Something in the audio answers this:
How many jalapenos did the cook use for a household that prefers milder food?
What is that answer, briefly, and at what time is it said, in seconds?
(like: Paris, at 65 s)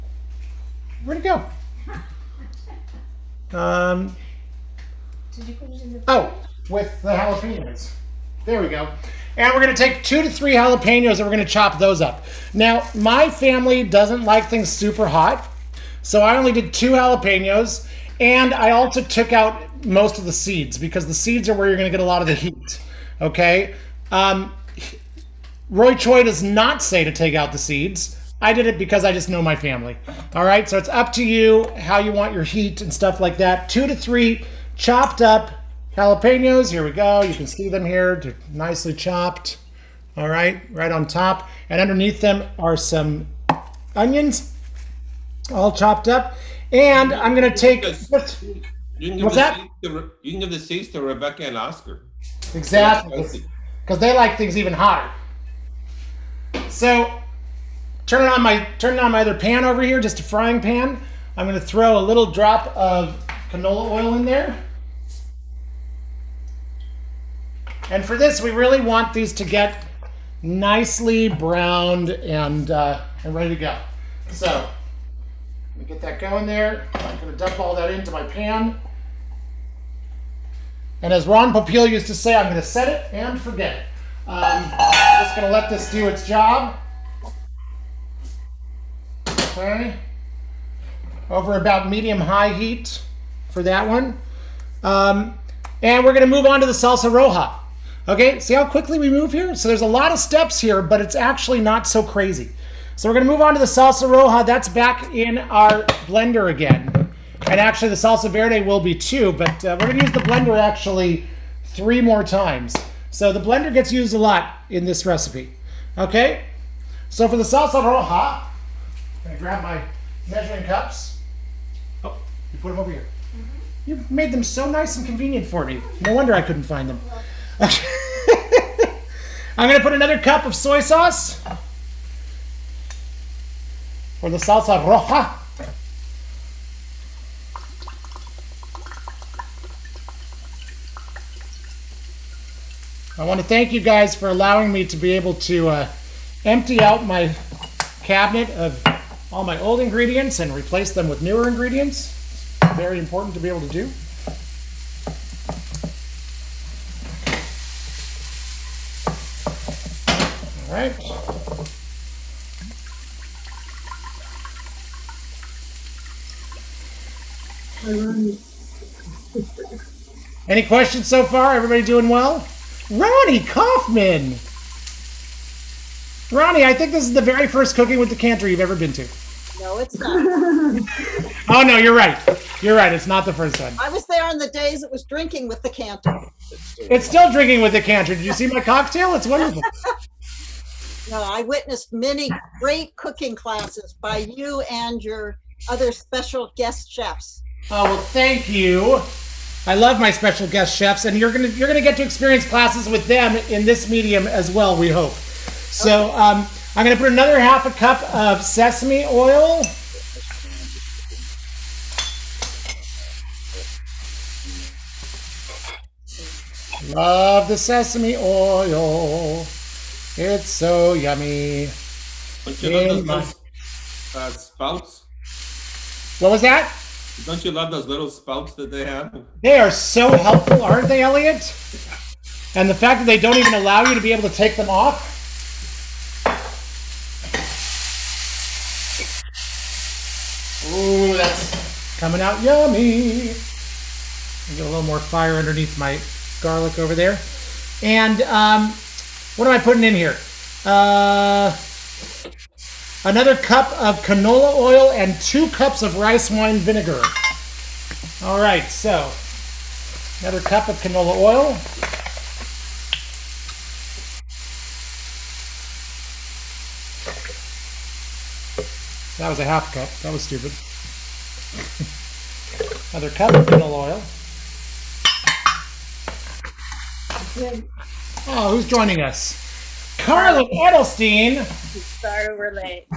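2, at 16 s.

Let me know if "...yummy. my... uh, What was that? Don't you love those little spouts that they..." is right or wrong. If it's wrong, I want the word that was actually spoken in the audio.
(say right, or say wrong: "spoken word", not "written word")
right.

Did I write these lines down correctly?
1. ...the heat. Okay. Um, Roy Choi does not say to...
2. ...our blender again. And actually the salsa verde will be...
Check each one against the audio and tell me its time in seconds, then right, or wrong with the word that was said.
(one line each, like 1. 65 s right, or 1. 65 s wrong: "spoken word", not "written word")
1. 22 s right
2. 105 s right.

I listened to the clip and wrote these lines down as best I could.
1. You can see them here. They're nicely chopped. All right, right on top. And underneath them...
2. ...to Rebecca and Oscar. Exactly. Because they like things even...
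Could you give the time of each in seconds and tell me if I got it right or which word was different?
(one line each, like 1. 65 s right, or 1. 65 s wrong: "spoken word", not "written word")
1. 37 s right
2. 50 s right.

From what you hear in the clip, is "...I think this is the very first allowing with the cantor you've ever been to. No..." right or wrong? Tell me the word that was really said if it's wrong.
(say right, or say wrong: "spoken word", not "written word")
wrong: "cooking", not "allowing".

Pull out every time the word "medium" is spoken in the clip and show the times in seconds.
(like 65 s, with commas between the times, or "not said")
91 s, 203 s.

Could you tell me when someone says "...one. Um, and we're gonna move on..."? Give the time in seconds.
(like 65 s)
93 s.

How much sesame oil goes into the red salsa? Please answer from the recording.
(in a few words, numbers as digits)
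half a cup.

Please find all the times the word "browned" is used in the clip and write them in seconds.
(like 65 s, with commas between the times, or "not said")
71 s.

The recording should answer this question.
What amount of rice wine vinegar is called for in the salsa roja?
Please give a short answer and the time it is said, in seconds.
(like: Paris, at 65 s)
2 cups, at 255 s.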